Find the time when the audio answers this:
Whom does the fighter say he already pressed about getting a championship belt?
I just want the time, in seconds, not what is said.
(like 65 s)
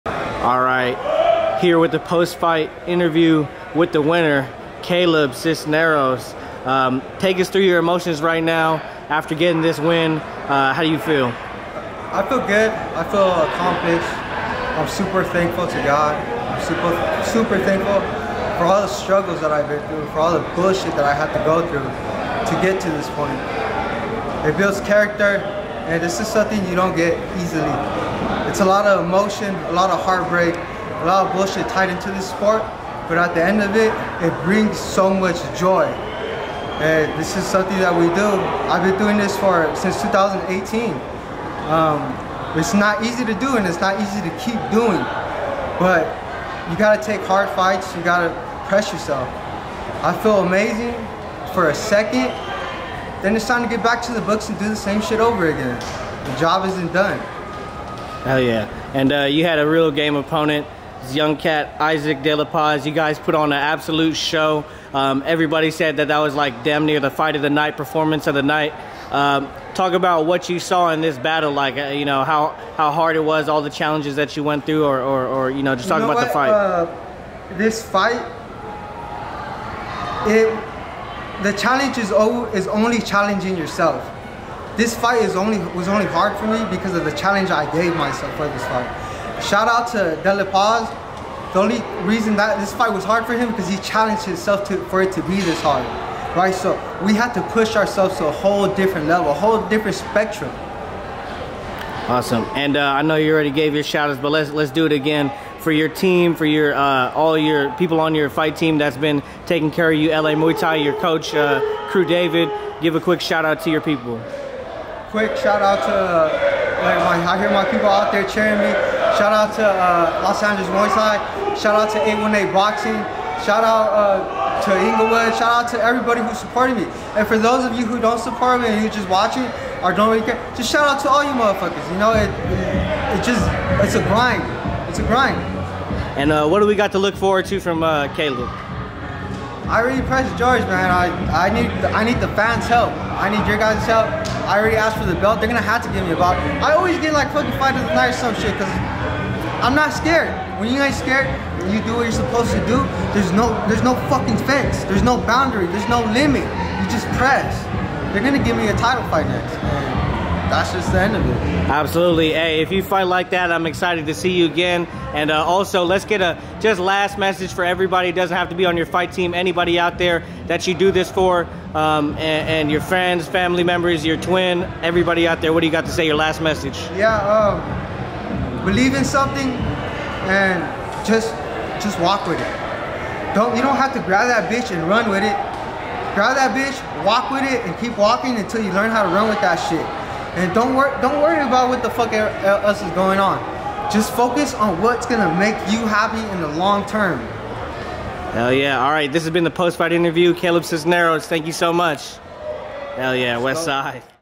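140 s.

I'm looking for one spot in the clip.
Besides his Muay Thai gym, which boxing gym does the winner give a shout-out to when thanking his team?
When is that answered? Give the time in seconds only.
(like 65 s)
122 s.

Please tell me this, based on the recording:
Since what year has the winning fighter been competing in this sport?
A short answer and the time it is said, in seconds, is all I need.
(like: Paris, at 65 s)
2018, at 40 s.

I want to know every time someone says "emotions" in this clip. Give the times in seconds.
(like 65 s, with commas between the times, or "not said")
7 s, 29 s.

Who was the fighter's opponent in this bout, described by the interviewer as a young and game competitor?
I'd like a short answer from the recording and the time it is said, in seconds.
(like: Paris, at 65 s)
Isaac De La Paz, at 61 s.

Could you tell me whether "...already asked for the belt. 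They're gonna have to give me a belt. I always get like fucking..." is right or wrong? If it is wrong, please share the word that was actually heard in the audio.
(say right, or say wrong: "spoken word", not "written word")
right.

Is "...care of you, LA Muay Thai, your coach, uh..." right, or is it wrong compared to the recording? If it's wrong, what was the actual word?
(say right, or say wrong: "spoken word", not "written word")
right.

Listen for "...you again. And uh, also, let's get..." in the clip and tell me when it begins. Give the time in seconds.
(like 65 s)
164 s.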